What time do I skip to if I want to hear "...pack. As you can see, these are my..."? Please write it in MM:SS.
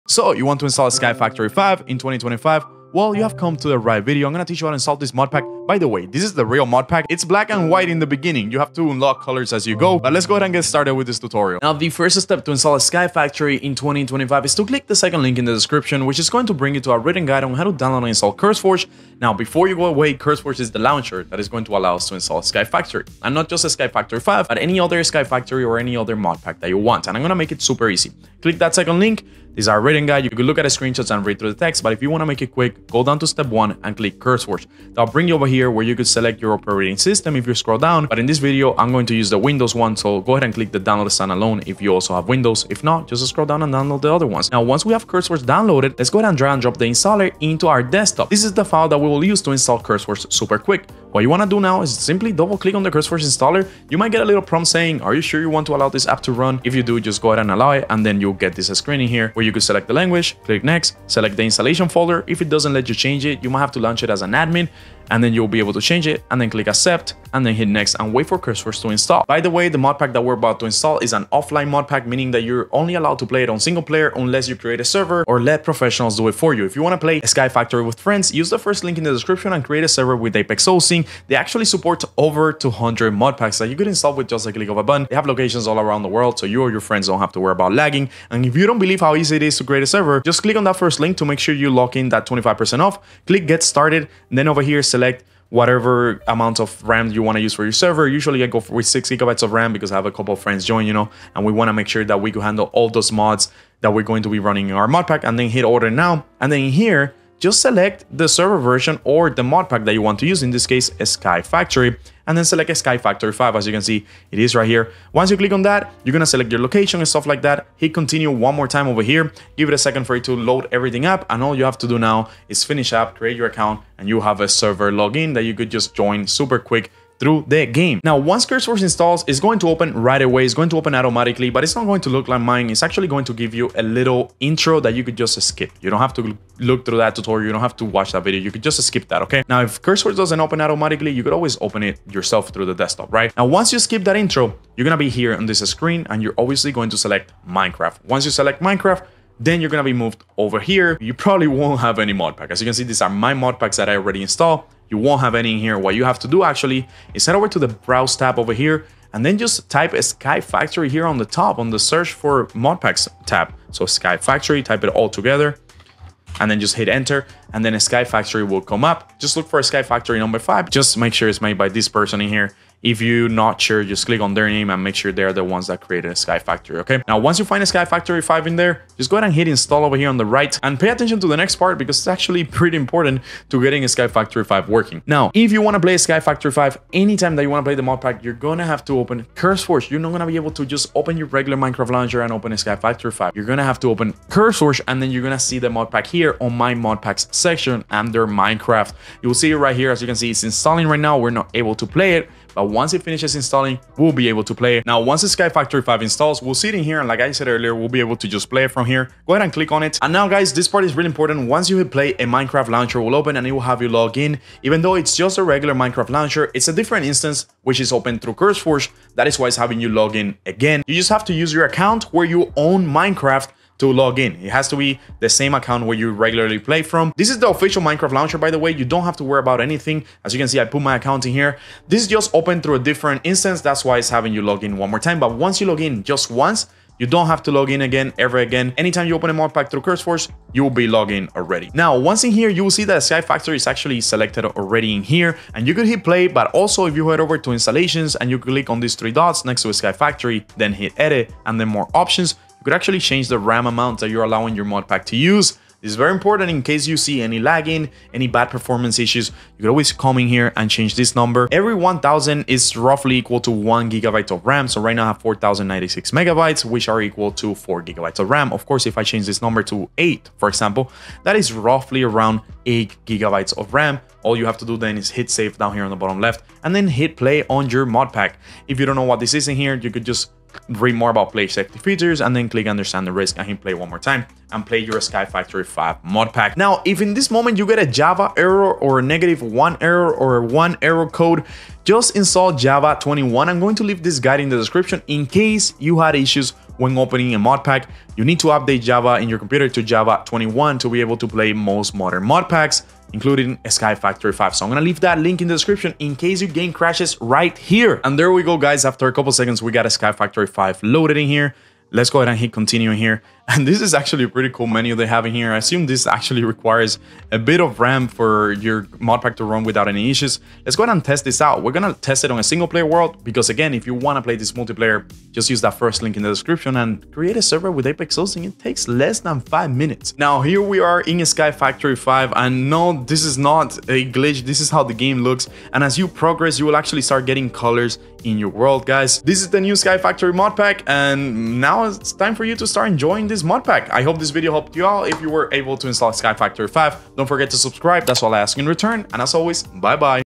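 02:32.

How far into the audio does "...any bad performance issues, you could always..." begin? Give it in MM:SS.
04:18.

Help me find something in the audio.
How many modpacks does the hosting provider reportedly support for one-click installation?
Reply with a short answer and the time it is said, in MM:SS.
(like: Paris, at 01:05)
over 200, at 01:22.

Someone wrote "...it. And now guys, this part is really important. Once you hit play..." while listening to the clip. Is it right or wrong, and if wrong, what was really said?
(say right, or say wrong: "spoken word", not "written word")
right.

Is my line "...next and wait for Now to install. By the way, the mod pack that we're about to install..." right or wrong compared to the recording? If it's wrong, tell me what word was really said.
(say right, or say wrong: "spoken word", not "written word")
wrong: "CurseForge", not "Now".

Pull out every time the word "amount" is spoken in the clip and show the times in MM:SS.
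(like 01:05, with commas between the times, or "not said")
01:36, 04:13.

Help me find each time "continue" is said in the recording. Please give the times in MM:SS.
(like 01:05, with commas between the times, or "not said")
01:57, 05:12.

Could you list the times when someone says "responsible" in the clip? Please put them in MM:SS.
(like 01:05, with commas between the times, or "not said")
not said.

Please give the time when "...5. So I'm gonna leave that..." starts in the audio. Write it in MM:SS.
05:04.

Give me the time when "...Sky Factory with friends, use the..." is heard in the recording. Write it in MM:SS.
01:17.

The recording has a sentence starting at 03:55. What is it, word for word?
But once you log in just once, you don't have to log in again ever again.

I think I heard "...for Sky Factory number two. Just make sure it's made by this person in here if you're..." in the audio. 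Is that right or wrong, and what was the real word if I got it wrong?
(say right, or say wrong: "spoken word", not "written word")
wrong: "five", not "two".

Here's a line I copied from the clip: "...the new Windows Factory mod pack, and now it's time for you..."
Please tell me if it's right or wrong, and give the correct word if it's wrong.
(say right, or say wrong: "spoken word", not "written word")
wrong: "Sky", not "Windows".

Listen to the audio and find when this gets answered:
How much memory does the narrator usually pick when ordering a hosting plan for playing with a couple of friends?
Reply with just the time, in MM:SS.
01:38.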